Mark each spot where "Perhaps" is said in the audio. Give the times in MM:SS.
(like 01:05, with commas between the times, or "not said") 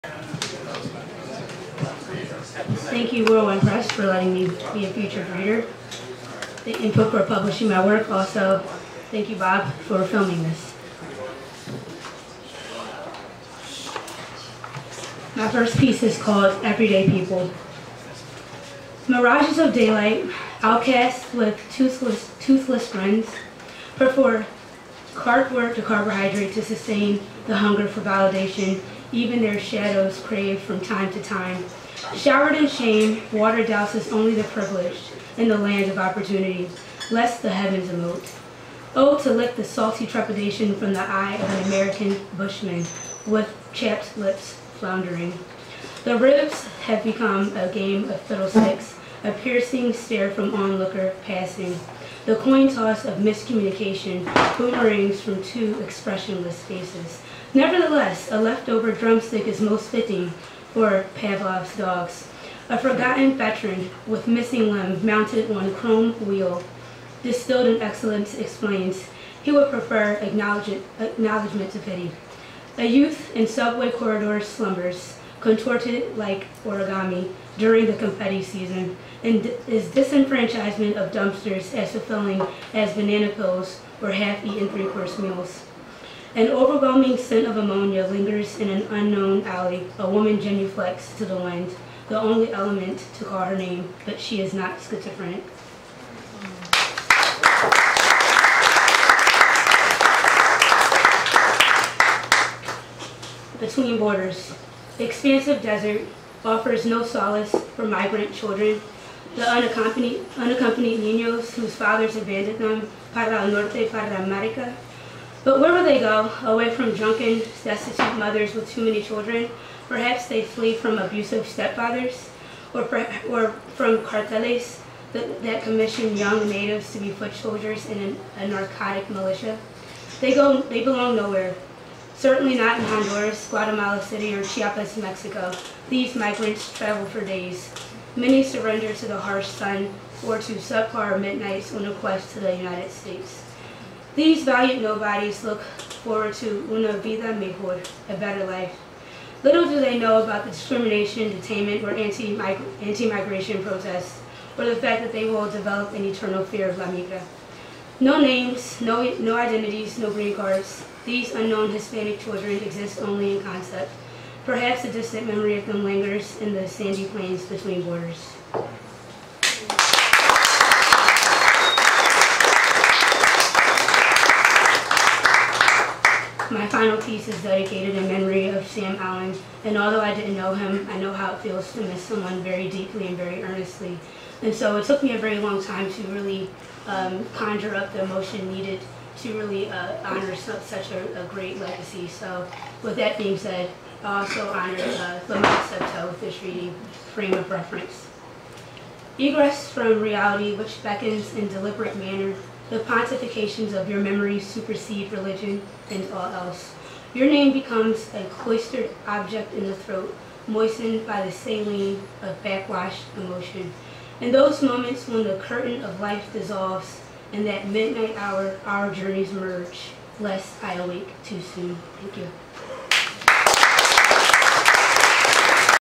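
01:59, 02:44.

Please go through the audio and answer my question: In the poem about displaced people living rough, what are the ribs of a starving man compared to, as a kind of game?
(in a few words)
fiddlesticks.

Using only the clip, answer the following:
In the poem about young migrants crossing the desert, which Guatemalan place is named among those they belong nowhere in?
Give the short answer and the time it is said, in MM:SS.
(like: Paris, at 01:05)
Guatemala City, at 02:13.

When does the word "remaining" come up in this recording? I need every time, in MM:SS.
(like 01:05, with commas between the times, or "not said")
not said.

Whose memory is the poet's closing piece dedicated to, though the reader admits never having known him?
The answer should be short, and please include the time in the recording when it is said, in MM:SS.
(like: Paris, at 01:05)
Sam Allen, at 02:58.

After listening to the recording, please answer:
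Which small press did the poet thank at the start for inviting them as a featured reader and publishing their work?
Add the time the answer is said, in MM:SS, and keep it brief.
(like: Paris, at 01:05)
Whirlwind Press, at 00:03.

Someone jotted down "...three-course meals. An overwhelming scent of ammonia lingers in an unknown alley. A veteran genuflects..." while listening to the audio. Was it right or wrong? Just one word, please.
wrong.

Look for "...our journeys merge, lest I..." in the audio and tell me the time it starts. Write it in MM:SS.
03:38.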